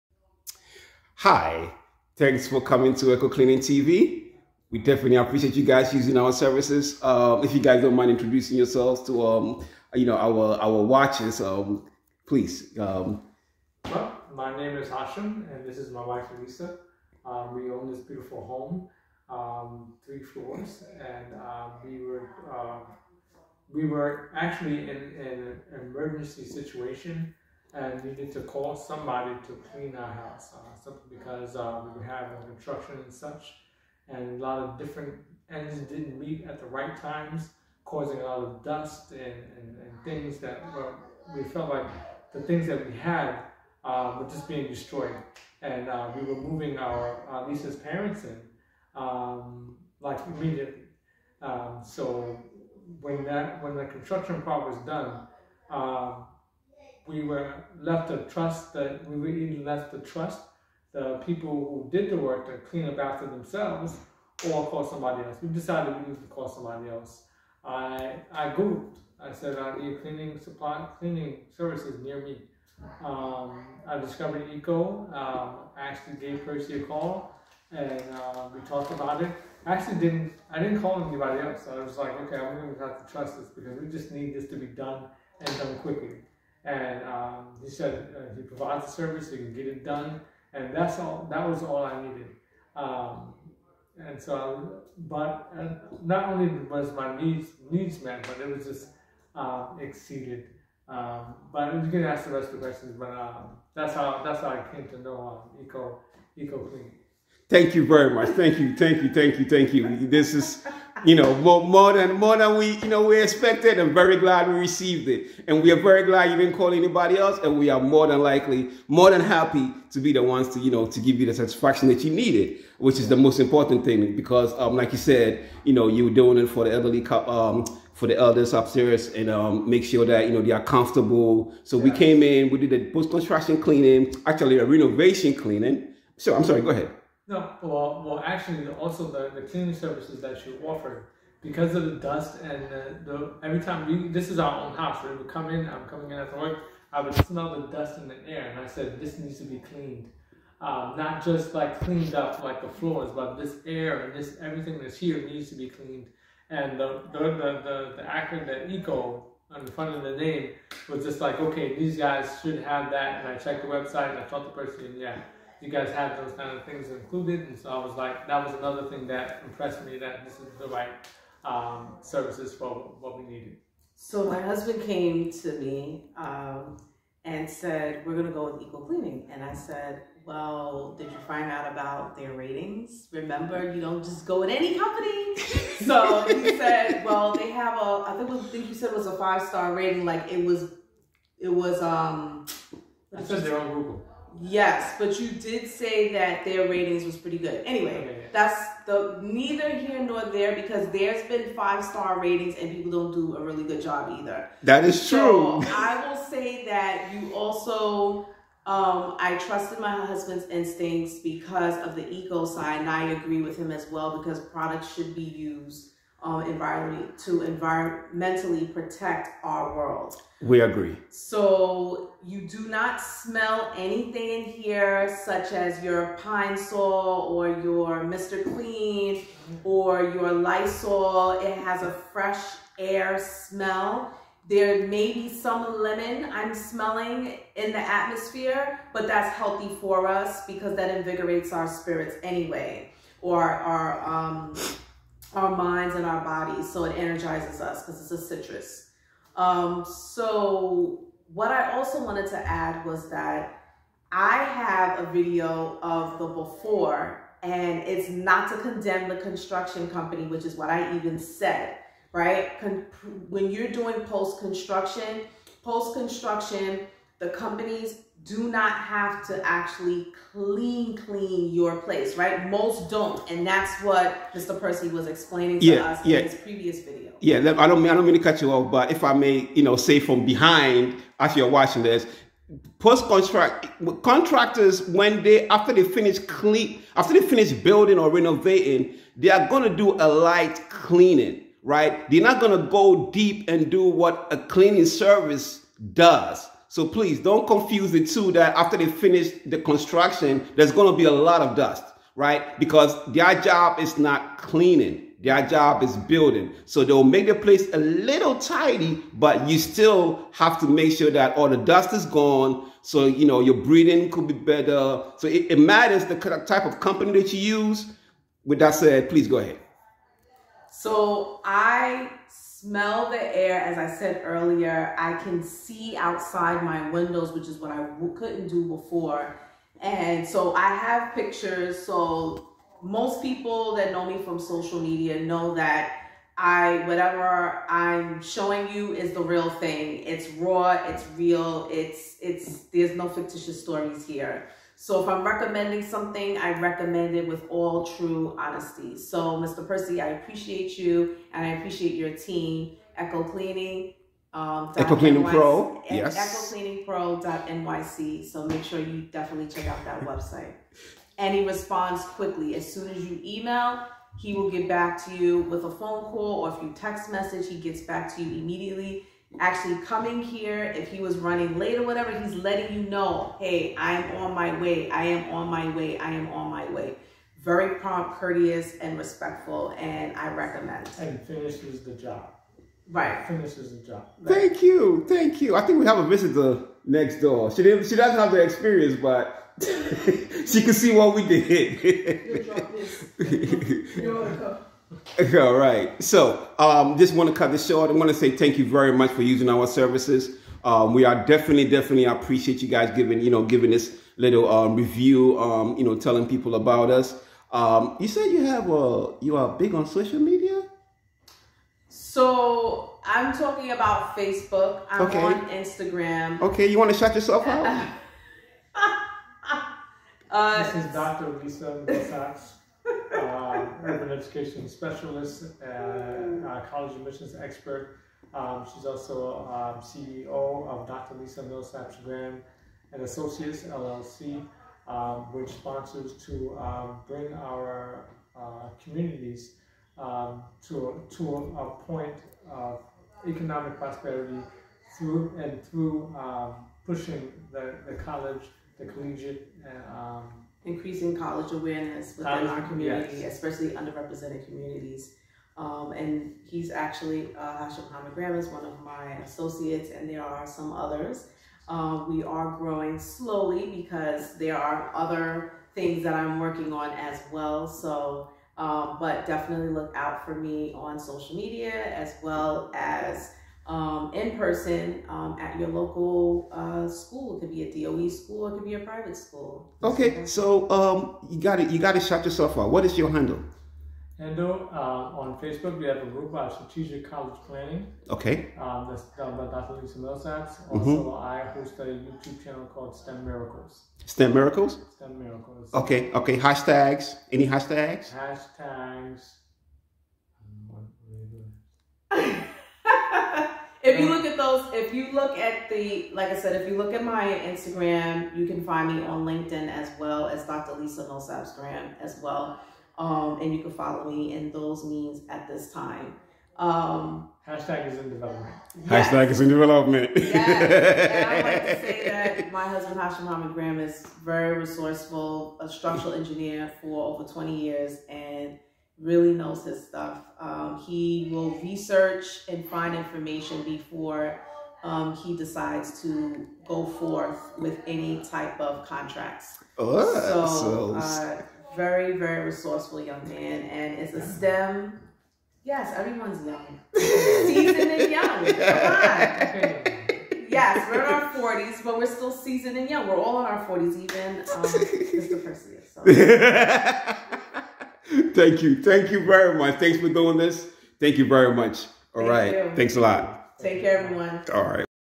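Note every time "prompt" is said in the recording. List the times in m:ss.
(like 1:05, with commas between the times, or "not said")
6:17.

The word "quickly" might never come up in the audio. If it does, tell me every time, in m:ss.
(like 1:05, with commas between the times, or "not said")
1:25, 6:02.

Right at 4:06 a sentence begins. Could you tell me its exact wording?
So it energizes us because it's a citrus.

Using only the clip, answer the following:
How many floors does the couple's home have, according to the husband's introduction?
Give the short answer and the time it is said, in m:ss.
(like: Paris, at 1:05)
3, at 0:20.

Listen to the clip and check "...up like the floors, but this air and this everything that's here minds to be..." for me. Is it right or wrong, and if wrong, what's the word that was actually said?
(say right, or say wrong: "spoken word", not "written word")
wrong: "needs", not "minds".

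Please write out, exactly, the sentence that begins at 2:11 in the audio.
So we came in, we did the post construction cleaning, actually a renovation cleaning.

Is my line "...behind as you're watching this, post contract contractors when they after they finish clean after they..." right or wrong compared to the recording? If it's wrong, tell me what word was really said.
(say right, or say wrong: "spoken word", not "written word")
right.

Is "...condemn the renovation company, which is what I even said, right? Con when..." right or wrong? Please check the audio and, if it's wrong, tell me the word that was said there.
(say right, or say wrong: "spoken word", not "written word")
wrong: "construction", not "renovation".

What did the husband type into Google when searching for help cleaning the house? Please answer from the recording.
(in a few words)
Cleaning services near me.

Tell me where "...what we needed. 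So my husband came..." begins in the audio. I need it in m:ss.
2:52.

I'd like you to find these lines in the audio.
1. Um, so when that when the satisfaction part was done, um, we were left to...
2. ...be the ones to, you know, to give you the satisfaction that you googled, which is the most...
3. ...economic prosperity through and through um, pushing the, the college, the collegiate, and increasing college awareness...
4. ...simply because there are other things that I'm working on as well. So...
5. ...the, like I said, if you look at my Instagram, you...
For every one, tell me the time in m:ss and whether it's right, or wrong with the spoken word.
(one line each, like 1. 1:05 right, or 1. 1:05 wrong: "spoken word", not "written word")
1. 0:51 wrong: "construction", not "satisfaction"
2. 1:59 wrong: "needed", not "googled"
3. 7:23 right
4. 7:42 wrong: "slowly", not "simply"
5. 8:25 right.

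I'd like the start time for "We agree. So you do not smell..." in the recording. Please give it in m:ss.
3:40.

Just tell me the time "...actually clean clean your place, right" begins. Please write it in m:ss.
4:29.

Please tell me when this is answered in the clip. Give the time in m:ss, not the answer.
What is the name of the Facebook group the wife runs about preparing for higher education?
8:06.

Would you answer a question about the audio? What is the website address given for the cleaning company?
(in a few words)
EcoCleaningPro.nyc.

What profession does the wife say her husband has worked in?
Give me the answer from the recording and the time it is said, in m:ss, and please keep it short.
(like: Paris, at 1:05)
Structural engineer, at 8:45.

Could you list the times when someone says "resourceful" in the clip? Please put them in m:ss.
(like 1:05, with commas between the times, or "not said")
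8:44, 9:02.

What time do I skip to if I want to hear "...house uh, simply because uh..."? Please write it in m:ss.
0:30.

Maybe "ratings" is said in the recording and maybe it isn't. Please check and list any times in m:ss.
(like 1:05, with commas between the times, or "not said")
3:02, 3:09, 3:16, 3:22.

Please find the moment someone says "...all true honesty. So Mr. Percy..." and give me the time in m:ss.
5:47.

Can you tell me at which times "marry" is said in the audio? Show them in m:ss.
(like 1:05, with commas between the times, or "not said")
not said.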